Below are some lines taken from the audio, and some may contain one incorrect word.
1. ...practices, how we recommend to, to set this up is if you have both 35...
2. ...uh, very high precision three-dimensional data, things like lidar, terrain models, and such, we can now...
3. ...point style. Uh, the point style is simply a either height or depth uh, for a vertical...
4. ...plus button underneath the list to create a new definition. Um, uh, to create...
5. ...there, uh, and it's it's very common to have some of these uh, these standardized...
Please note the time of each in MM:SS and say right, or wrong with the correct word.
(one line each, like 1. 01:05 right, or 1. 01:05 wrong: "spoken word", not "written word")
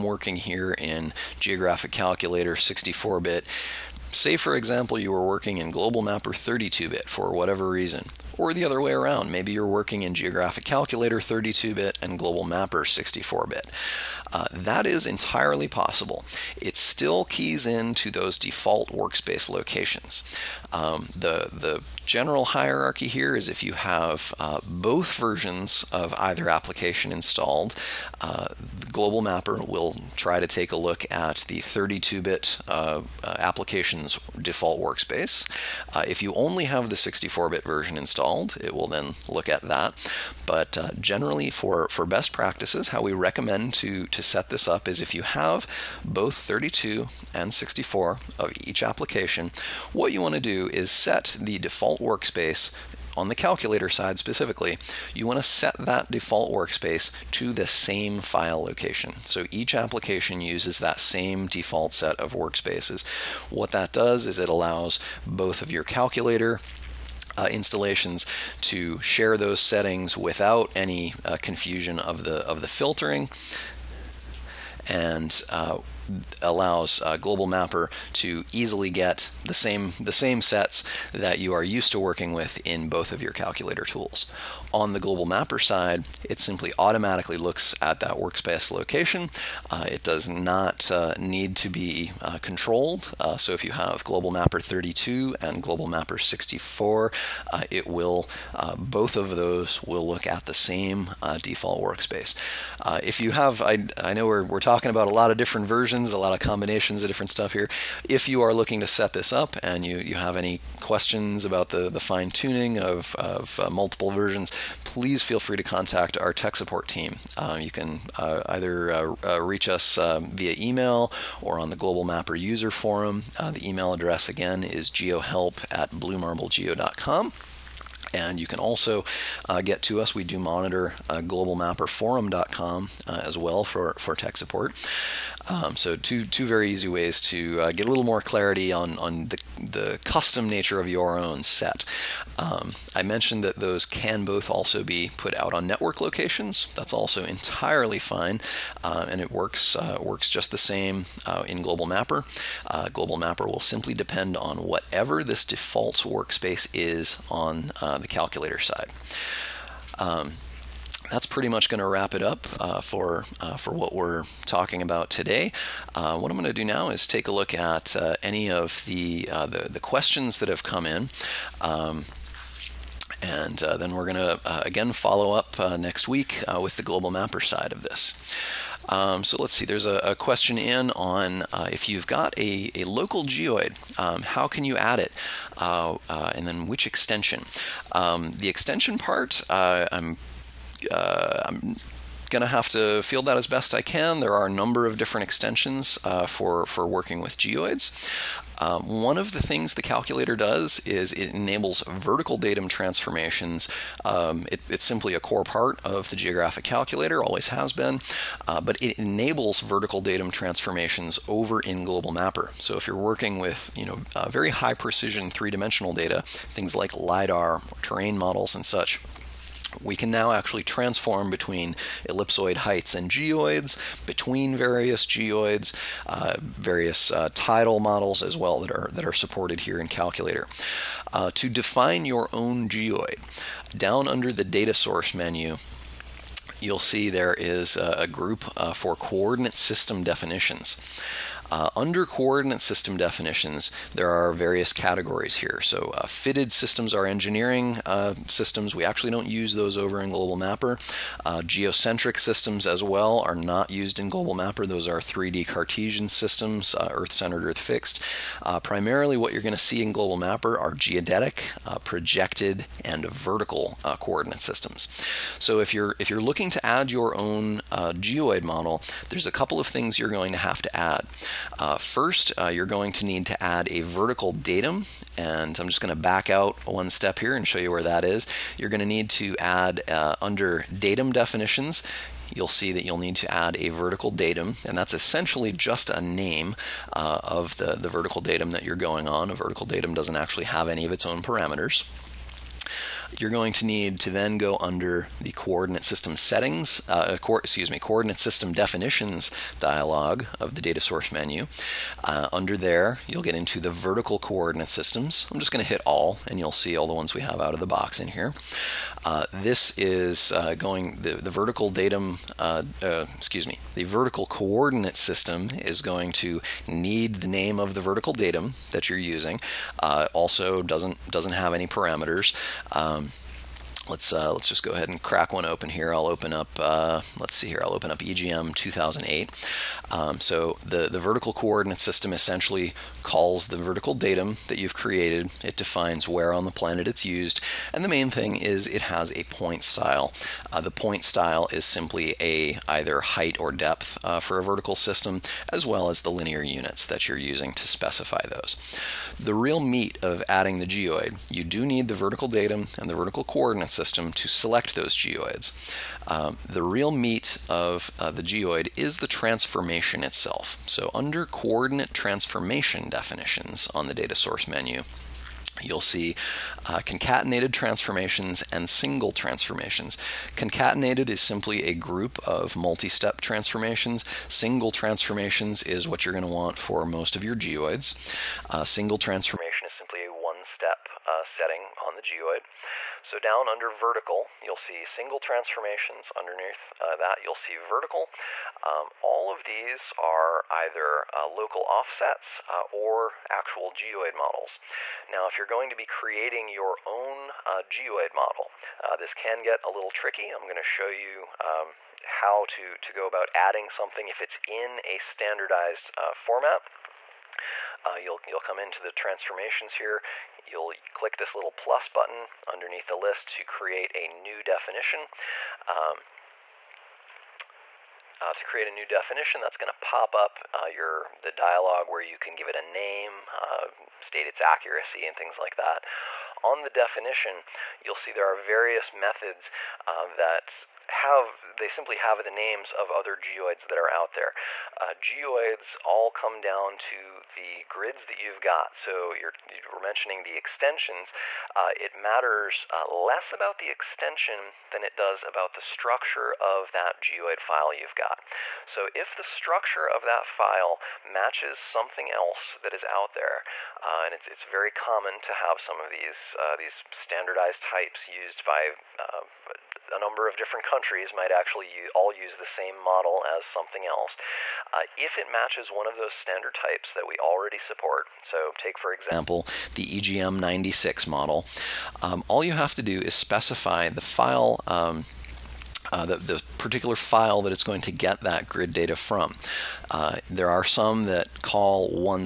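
1. 00:42 wrong: "32", not "35"
2. 03:34 right
3. 05:39 right
4. 06:51 right
5. 07:33 right.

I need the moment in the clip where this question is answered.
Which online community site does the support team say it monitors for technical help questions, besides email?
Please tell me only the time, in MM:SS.
02:11.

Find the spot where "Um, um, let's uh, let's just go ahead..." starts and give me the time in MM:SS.
05:22.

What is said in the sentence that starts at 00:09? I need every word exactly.
Maybe you're working in Geographic Calculator 32 bit and Global Mapper 64 bit.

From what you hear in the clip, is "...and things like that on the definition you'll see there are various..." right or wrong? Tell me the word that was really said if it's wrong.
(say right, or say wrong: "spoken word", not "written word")
right.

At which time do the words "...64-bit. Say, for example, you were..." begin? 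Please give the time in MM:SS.
00:02.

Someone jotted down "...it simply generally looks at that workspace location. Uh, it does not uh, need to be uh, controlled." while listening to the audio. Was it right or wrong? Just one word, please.
wrong.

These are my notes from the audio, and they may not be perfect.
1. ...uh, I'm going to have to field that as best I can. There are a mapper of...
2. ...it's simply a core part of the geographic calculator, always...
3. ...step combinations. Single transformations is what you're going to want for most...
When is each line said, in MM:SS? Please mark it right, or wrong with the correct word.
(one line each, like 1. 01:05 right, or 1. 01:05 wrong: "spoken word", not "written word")
1. 03:10 wrong: "number", not "mapper"
2. 03:24 right
3. 06:12 wrong: "transformations", not "combinations".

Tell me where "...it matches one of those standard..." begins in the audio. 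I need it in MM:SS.
07:45.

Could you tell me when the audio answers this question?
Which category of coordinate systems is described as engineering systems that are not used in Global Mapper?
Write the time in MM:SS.
04:06.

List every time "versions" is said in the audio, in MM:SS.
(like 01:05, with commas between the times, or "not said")
00:25, 00:37, 01:45, 01:54.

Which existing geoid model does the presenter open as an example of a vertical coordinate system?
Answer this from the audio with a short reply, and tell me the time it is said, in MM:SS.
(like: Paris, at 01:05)
EGM 2008, at 05:27.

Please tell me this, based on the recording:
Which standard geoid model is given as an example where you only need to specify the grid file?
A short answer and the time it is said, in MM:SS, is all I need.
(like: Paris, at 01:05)
EGM96, at 07:49.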